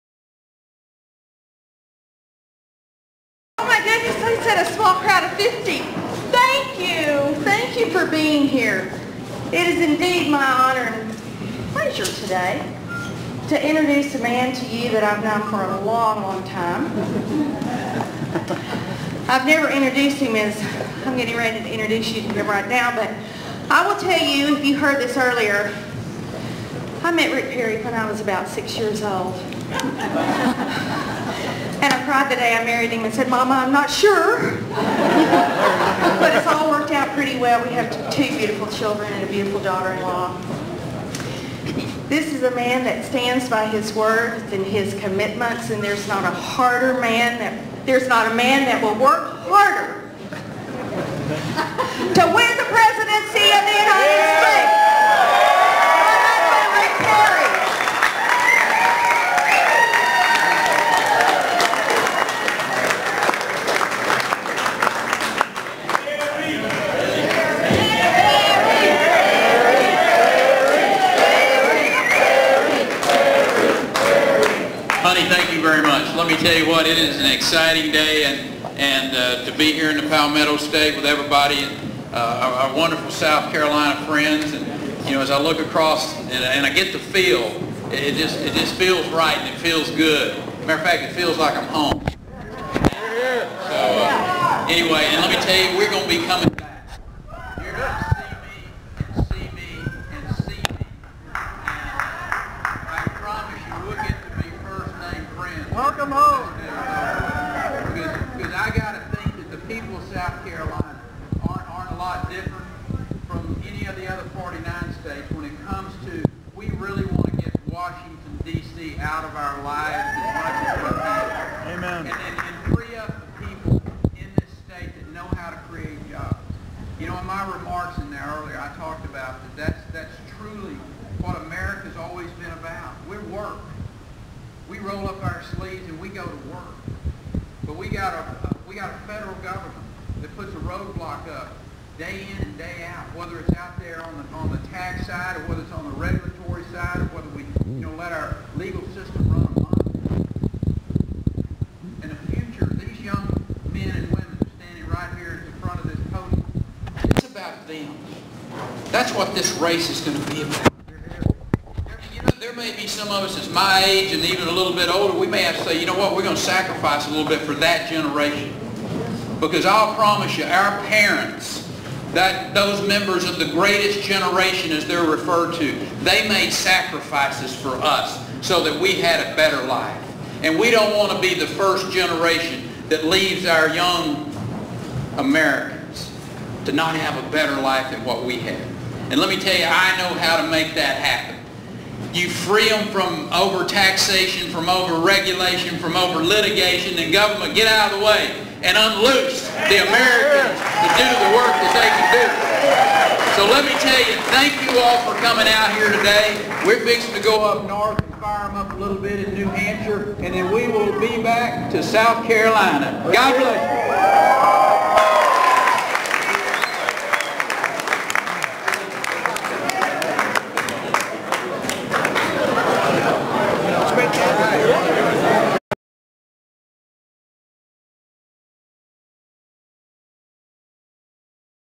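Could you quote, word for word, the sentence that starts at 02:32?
In the future, these young men and women standing right here in front of this podium, it's about them.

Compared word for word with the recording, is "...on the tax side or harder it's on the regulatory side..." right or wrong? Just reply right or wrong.
wrong.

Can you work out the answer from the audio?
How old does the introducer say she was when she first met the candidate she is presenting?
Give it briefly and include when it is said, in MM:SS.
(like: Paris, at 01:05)
six years old, at 00:28.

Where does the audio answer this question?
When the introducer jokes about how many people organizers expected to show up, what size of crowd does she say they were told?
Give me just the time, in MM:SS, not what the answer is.
00:05.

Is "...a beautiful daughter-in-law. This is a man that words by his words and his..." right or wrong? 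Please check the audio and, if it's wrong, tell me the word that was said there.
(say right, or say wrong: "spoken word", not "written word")
wrong: "stands", not "words".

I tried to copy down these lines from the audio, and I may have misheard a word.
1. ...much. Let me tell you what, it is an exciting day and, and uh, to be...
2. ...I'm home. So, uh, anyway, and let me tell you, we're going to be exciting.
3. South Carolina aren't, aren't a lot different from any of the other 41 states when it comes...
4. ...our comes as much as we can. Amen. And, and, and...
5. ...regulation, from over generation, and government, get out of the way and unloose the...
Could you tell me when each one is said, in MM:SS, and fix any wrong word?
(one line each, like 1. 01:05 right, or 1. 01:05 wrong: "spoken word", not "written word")
1. 01:15 right
2. 01:31 wrong: "coming", not "exciting"
3. 01:50 wrong: "49", not "41"
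4. 01:59 wrong: "lives", not "comes"
5. 03:15 wrong: "litigation", not "generation".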